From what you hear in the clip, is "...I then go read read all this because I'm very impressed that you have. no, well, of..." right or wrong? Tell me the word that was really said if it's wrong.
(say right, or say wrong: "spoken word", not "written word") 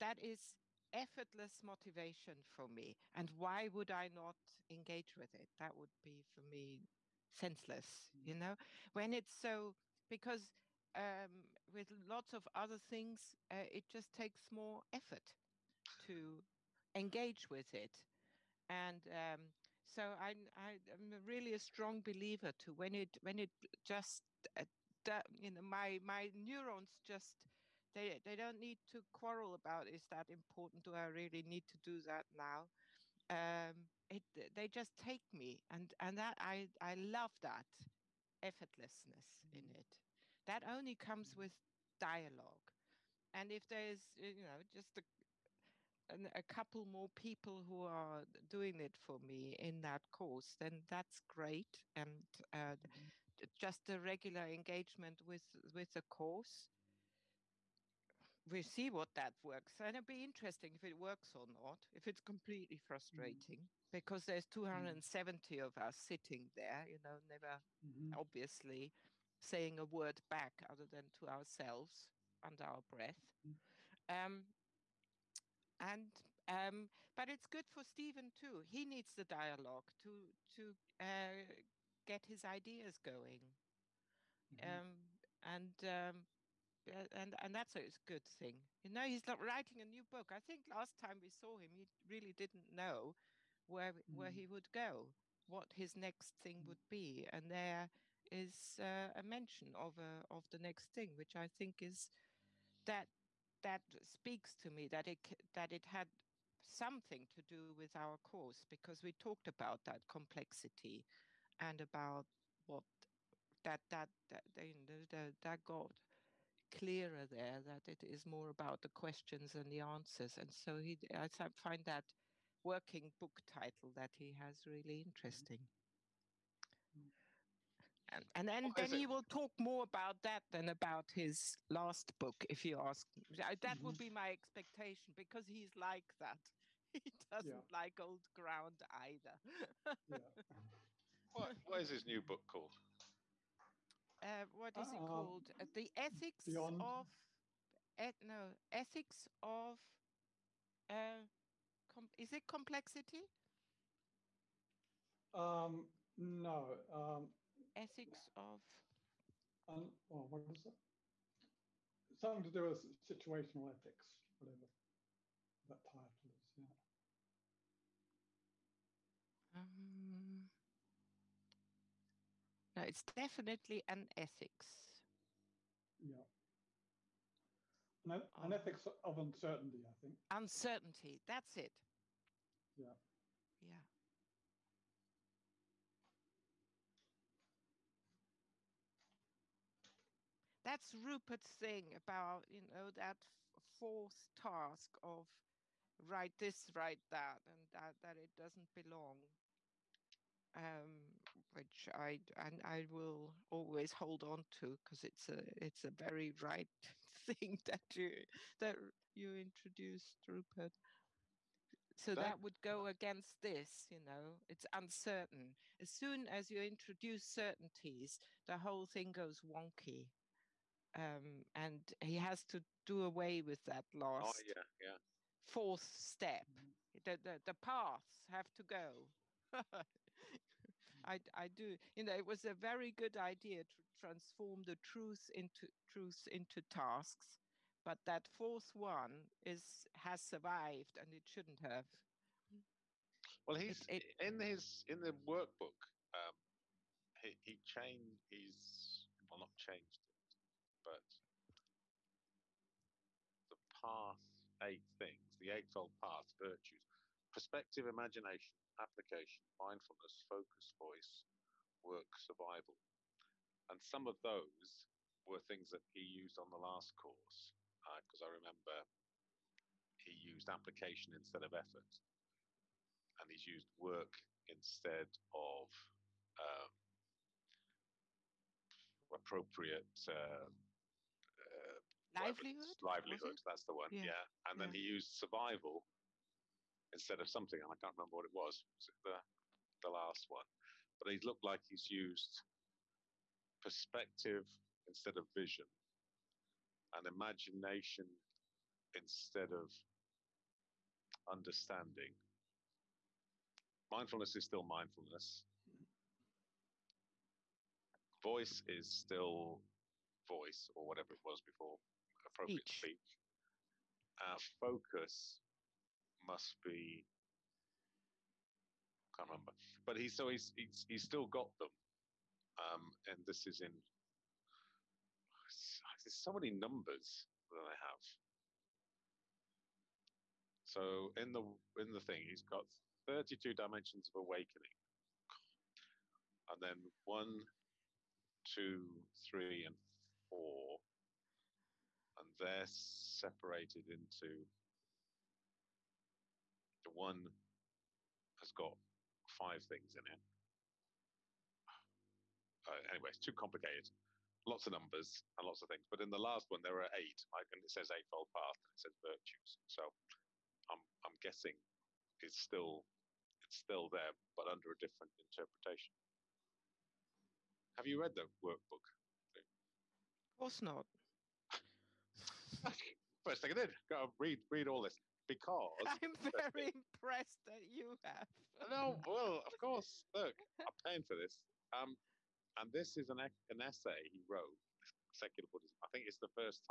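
right.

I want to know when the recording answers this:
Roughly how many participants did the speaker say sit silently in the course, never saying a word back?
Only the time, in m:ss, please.
1:04.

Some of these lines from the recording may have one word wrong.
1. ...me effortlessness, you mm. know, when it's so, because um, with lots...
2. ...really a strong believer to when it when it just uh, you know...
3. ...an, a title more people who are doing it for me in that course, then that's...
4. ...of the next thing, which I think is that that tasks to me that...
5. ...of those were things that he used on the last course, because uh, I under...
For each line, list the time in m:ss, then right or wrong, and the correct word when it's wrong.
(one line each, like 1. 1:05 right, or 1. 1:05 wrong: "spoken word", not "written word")
1. 0:06 wrong: "senseless", not "effortlessness"
2. 0:21 right
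3. 0:46 wrong: "couple", not "title"
4. 1:40 wrong: "speaks", not "tasks"
5. 4:24 wrong: "remember", not "under".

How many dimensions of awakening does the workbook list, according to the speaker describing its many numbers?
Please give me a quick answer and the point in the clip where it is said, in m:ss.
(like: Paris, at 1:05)
32, at 5:33.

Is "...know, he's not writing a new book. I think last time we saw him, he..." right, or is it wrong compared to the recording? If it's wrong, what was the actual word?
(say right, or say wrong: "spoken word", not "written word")
right.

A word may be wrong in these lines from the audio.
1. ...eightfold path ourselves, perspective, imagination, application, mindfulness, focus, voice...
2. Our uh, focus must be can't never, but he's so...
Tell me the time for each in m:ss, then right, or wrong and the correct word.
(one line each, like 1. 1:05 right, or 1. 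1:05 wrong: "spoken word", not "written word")
1. 4:15 wrong: "virtues", not "ourselves"
2. 5:14 wrong: "remember", not "never".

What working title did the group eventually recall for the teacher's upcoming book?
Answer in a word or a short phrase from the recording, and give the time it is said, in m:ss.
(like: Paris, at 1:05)
Ethics of Uncertainty, at 2:58.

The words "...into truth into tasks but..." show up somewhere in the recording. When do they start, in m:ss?
3:55.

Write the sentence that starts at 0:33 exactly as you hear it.
Um, it they just take me and and that I I love that effortlessness mm-hmm.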